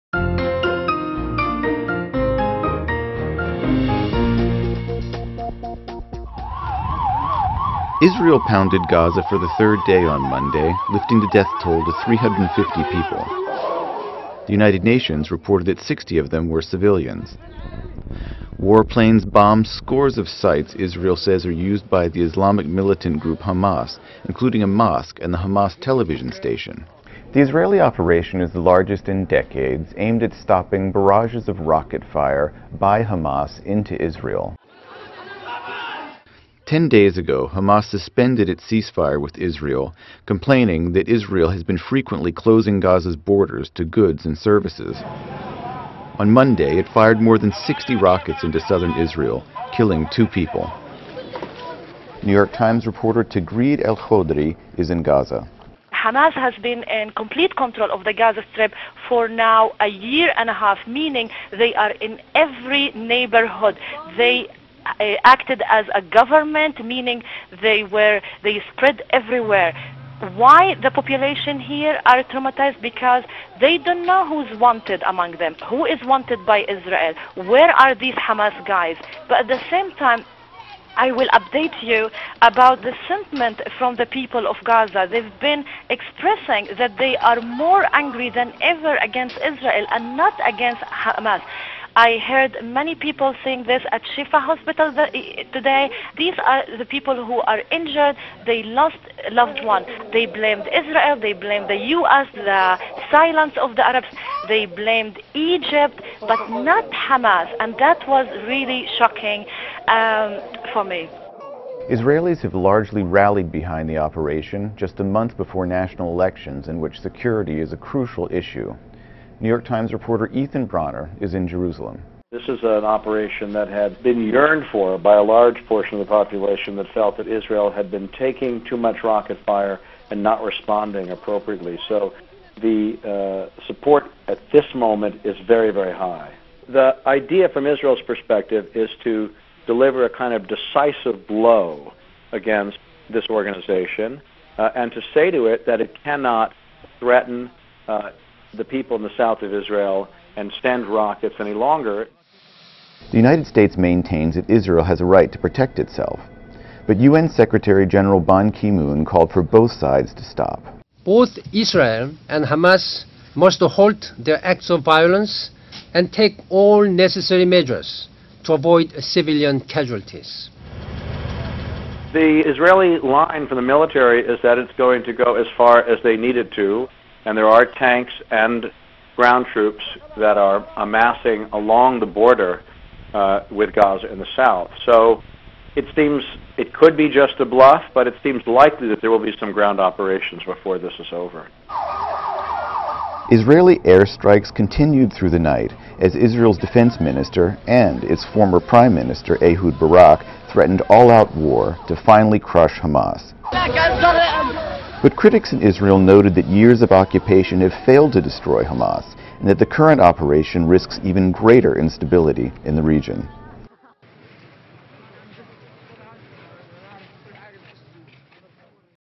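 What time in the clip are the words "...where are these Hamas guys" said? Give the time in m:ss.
1:17.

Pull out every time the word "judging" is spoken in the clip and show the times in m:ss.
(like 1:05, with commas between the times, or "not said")
not said.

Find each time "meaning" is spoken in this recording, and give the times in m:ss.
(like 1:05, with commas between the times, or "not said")
1:00, 1:06.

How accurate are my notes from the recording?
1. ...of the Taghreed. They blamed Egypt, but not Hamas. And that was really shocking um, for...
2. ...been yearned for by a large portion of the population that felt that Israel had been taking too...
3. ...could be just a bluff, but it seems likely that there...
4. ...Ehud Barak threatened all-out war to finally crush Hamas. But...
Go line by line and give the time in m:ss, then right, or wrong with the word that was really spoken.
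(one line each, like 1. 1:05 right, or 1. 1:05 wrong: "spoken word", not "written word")
1. 1:43 wrong: "Arabs", not "Taghreed"
2. 2:04 right
3. 3:06 right
4. 3:19 right.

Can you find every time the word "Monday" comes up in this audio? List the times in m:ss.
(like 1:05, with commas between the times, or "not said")
0:10, 0:46.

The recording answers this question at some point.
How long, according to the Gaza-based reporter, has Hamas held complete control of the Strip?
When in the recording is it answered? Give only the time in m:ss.
0:59.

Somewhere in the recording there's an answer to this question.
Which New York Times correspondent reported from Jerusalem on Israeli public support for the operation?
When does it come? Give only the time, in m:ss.
2:00.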